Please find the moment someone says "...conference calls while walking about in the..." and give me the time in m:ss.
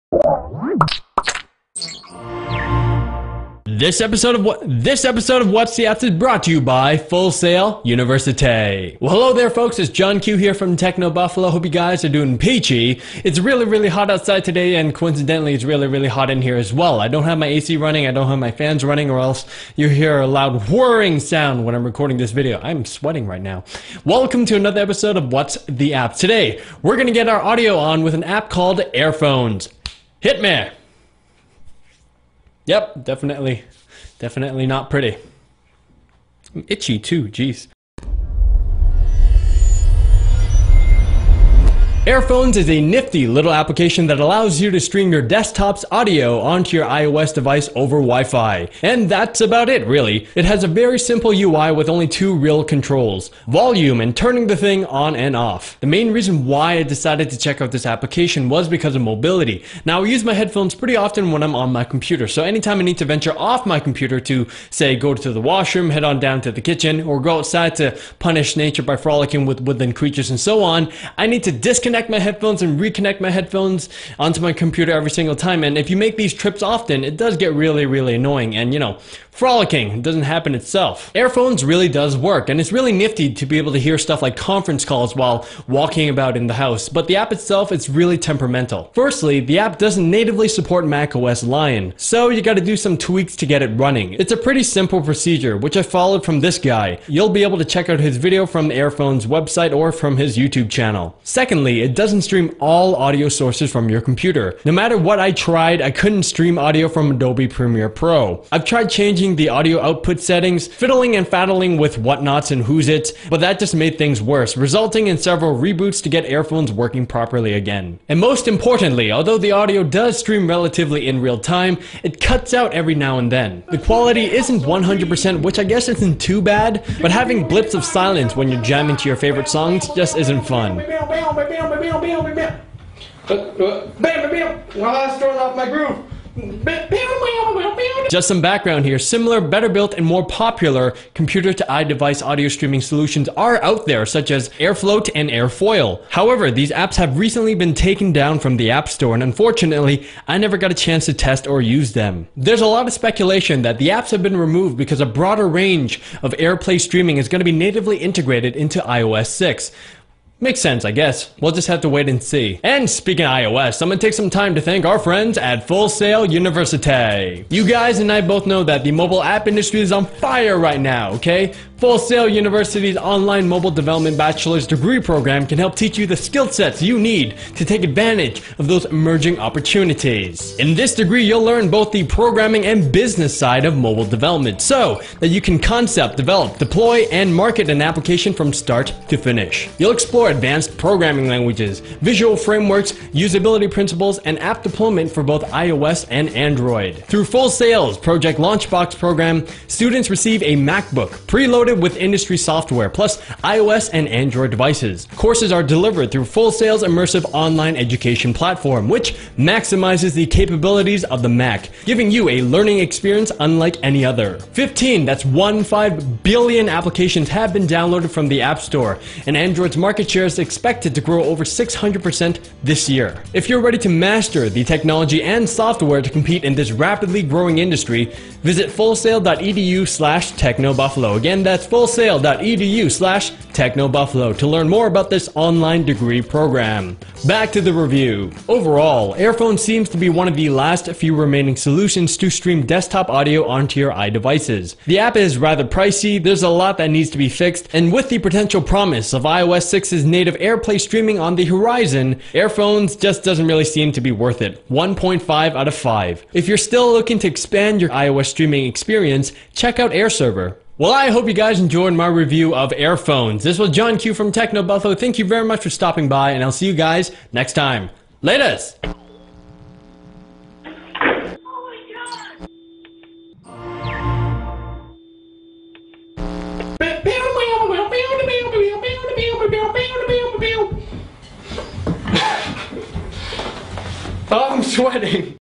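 1:24.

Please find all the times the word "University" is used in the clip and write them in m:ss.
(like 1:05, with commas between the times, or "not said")
0:07, 2:46, 2:52.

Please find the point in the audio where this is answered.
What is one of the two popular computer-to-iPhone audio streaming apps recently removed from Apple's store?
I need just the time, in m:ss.
2:24.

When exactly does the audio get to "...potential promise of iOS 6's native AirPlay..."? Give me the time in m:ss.
4:08.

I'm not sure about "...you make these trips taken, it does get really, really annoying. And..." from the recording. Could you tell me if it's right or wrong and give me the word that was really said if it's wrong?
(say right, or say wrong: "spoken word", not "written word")
wrong: "often", not "taken".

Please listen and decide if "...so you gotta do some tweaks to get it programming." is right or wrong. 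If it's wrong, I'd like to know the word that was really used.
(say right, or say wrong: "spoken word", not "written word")
wrong: "running", not "programming".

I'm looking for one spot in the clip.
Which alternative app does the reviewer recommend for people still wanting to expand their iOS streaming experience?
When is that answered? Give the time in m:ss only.
4:19.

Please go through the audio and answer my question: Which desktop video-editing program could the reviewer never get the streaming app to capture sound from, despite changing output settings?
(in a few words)
Adobe Premiere Pro.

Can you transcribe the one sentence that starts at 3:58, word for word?
Overall, Airphone seems to be one of the last few remaining solutions to stream desktop audio onto your iDevices.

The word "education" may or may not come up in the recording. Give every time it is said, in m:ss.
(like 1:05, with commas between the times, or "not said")
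3:27.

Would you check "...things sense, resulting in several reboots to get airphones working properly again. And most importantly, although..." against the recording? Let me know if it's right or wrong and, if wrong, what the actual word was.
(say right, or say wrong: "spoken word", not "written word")
wrong: "worse", not "sense".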